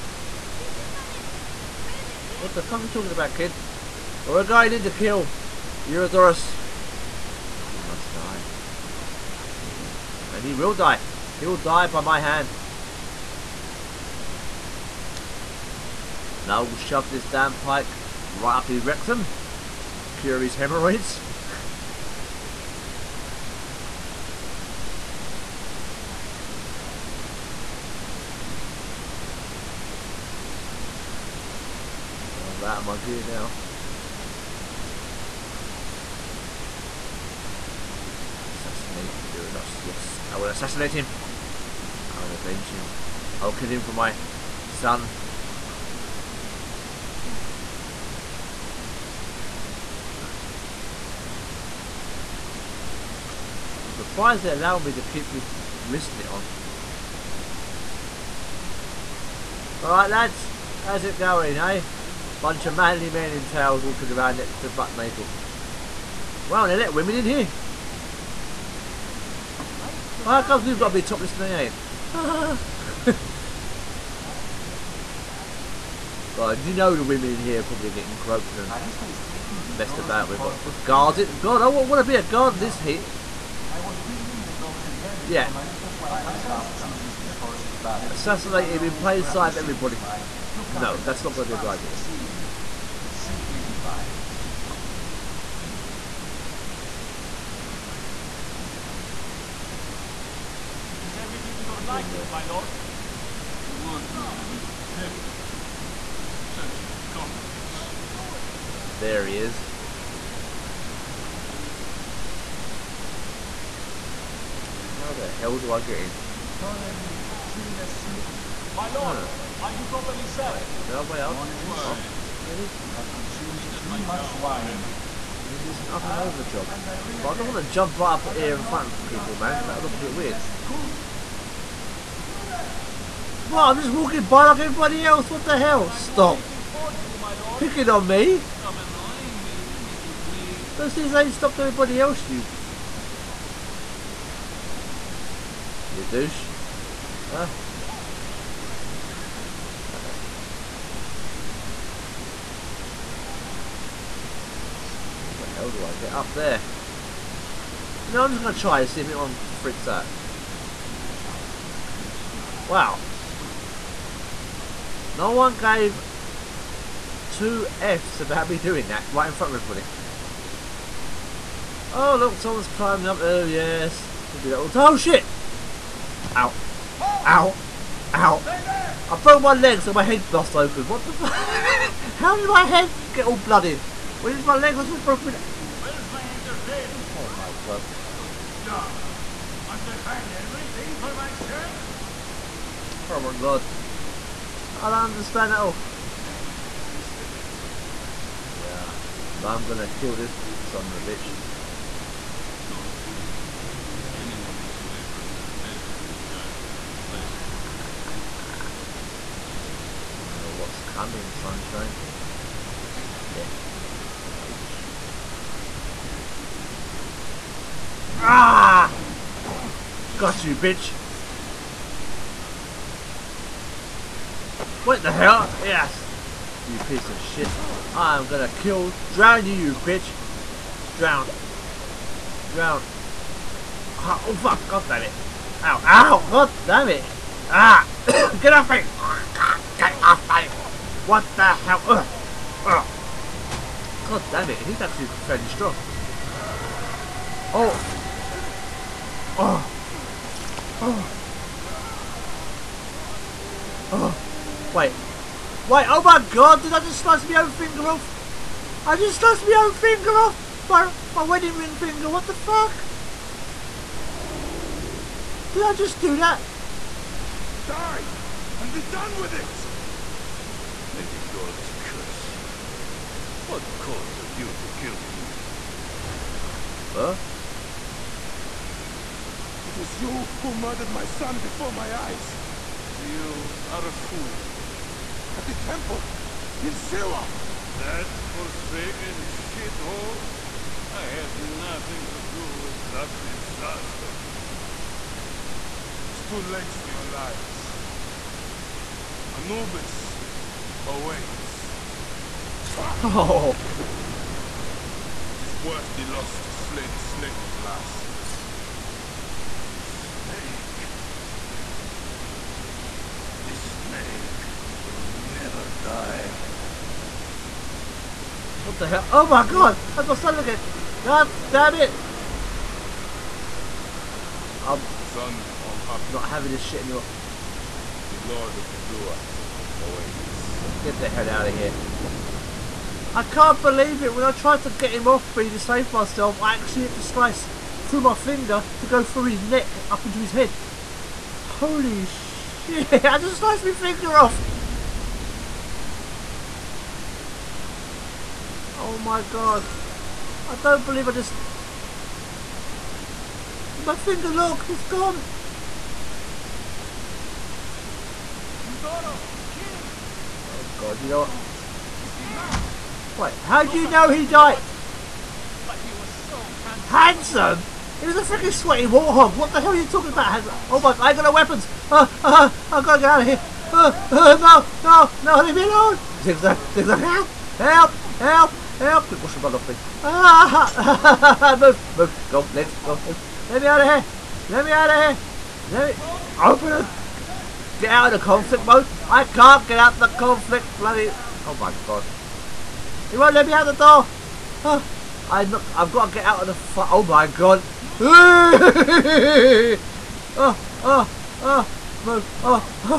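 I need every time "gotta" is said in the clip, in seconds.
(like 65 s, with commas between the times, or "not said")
372 s, 395 s.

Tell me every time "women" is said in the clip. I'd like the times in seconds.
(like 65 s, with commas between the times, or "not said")
66 s, 77 s.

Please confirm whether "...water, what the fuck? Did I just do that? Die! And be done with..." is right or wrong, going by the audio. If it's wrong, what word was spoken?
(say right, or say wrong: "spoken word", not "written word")
wrong: "finger", not "water".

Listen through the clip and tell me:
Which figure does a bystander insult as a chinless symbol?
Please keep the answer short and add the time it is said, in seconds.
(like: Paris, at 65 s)
Ptolemy, at 116 s.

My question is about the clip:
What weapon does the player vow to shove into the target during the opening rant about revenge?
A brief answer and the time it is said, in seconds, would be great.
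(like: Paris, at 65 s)
pike, at 17 s.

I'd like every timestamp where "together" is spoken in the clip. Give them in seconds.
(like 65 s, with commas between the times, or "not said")
not said.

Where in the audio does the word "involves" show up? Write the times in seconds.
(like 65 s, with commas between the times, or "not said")
not said.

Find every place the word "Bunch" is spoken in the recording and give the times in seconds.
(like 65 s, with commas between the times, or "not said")
62 s.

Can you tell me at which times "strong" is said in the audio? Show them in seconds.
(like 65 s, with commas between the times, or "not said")
245 s.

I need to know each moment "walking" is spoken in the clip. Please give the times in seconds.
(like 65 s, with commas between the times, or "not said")
63 s, 133 s.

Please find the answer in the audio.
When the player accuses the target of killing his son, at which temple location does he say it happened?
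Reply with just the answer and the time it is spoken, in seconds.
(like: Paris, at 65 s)
Siwa, at 286 s.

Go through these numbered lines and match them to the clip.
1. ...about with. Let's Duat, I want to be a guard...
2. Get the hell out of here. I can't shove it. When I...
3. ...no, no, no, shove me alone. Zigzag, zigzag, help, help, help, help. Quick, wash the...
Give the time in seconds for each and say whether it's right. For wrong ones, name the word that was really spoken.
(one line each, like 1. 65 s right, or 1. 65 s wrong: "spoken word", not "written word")
1. 79 s wrong: "God", not "Duat"
2. 330 s wrong: "believe", not "shove"
3. 374 s wrong: "leave", not "shove".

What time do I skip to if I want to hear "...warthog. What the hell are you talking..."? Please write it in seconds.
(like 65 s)
368 s.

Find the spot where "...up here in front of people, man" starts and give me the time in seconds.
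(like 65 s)
128 s.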